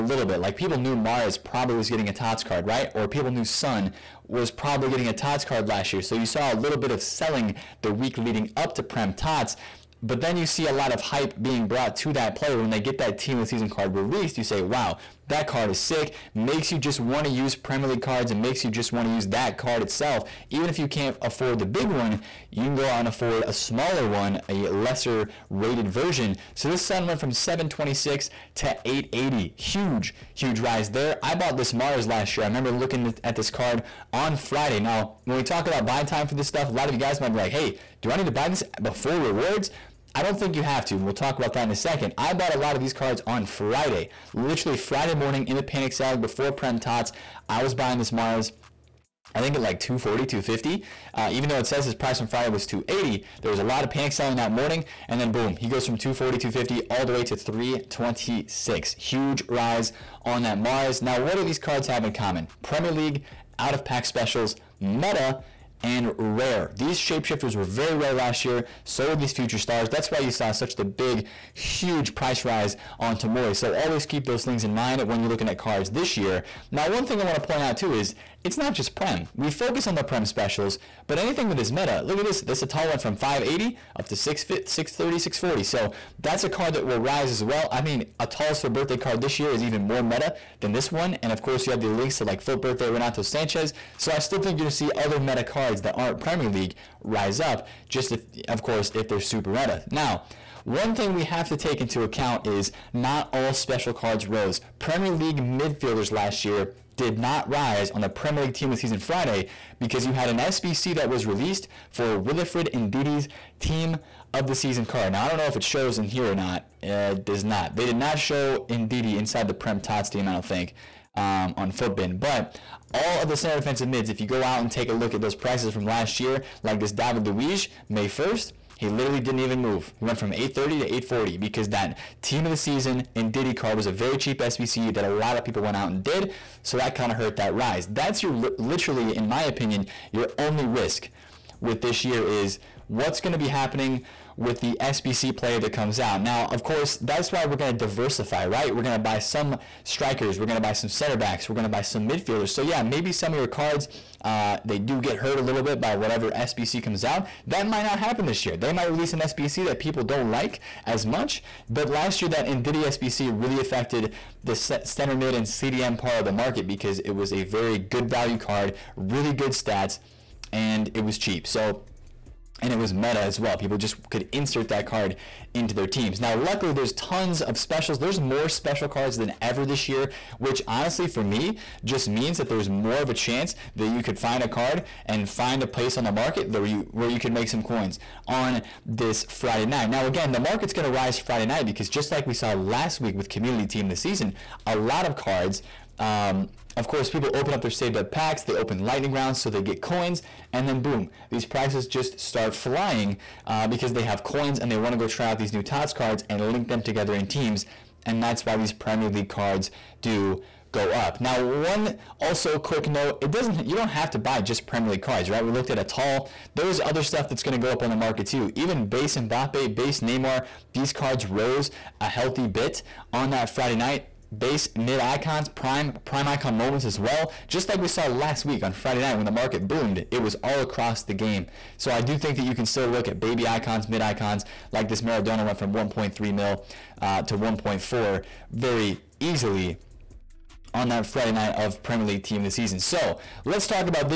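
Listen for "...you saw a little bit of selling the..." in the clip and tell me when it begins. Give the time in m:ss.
0:06.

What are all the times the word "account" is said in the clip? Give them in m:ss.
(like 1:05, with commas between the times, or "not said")
1:42.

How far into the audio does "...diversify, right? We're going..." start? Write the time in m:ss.
2:27.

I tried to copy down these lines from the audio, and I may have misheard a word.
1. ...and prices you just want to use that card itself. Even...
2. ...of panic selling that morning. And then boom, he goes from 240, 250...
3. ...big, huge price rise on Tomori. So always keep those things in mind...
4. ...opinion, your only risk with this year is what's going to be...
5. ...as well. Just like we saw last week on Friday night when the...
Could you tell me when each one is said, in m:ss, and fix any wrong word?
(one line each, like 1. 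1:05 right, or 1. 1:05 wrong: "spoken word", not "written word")
1. 0:18 wrong: "makes", not "prices"
2. 0:53 right
3. 1:10 right
4. 2:19 right
5. 3:46 right.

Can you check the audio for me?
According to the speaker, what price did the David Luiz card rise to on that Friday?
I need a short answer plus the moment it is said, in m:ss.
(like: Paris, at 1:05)
840, at 2:10.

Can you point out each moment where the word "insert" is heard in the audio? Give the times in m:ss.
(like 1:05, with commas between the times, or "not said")
2:54.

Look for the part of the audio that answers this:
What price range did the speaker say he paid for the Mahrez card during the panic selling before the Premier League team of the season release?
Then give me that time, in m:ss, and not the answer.
0:49.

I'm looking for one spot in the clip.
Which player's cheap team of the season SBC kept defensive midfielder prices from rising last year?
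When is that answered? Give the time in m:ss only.
1:52.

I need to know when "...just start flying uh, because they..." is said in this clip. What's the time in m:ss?
3:21.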